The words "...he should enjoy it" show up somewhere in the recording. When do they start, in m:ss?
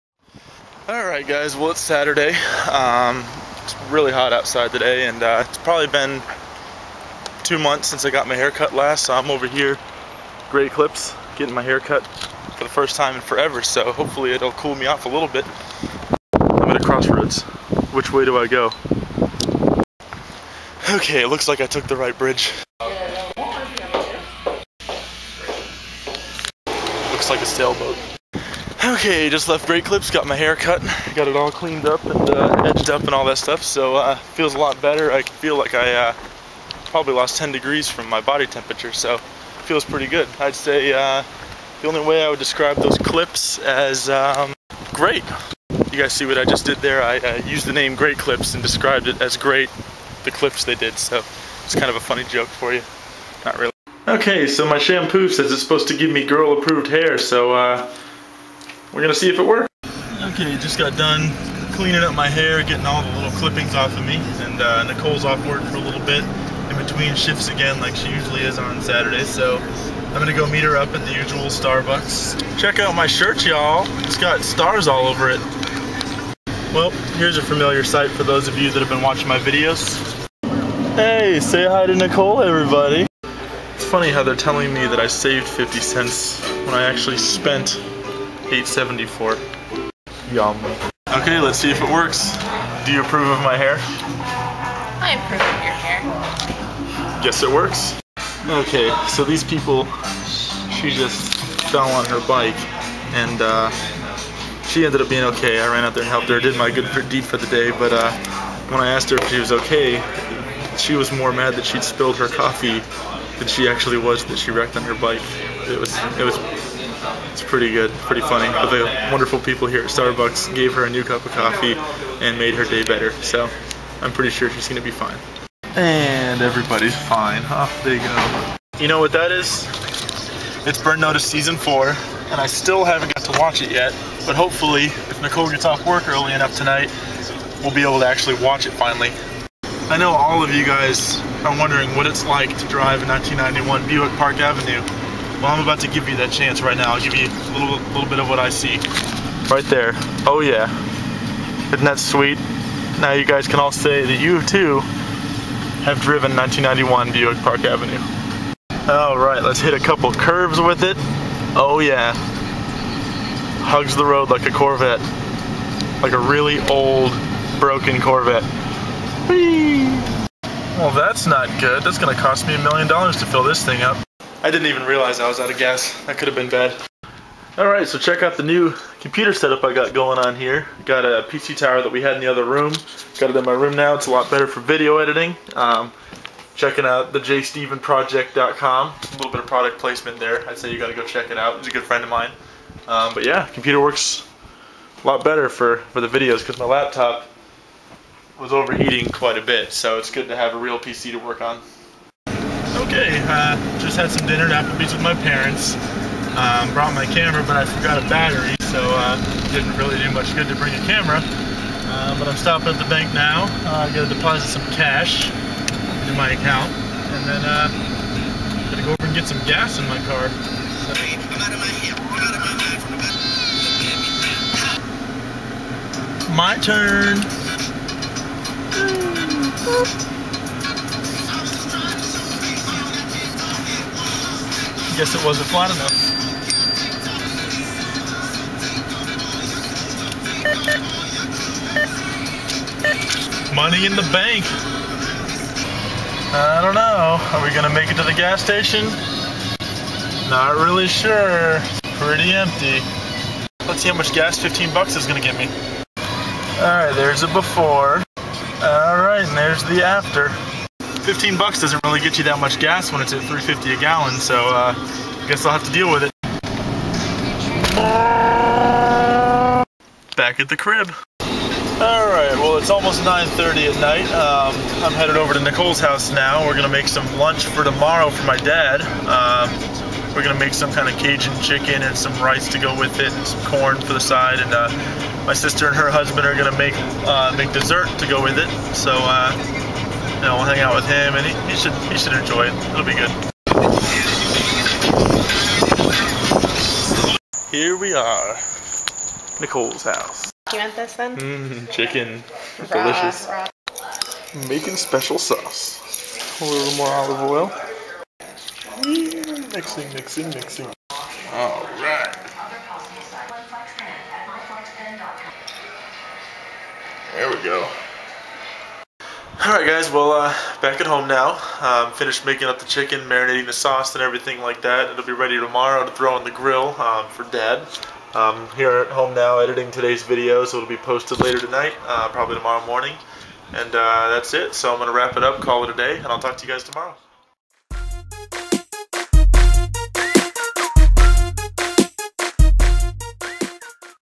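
4:51.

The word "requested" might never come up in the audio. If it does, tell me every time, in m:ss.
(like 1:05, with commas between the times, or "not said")
not said.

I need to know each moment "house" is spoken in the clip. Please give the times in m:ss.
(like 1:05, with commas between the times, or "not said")
4:35, 4:59.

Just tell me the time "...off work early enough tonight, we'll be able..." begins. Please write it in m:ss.
2:15.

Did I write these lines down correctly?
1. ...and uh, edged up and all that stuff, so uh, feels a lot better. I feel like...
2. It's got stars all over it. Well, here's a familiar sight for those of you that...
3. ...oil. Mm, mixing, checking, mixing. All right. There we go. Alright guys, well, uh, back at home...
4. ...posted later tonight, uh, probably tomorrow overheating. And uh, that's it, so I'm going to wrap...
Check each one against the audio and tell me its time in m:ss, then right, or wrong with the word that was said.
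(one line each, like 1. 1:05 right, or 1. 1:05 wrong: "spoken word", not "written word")
1. 0:32 right
2. 1:14 right
3. 5:07 wrong: "mixing", not "checking"
4. 5:30 wrong: "morning", not "overheating".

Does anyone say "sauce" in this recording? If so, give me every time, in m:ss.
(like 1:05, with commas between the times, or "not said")
5:05, 5:23.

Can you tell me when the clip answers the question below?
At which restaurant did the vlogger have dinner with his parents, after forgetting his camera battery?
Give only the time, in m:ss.
3:24.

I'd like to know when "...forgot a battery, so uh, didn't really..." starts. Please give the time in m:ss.
3:27.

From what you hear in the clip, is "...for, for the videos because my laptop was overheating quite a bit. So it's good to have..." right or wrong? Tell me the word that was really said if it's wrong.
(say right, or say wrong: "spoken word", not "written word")
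right.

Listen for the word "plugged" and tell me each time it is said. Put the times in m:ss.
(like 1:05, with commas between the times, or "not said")
not said.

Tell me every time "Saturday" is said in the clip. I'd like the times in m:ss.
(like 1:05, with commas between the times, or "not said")
0:01, 1:08.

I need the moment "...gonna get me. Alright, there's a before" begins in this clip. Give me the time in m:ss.
4:15.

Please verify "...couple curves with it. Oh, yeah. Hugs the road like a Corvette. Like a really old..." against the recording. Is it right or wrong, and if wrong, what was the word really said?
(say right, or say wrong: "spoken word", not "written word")
right.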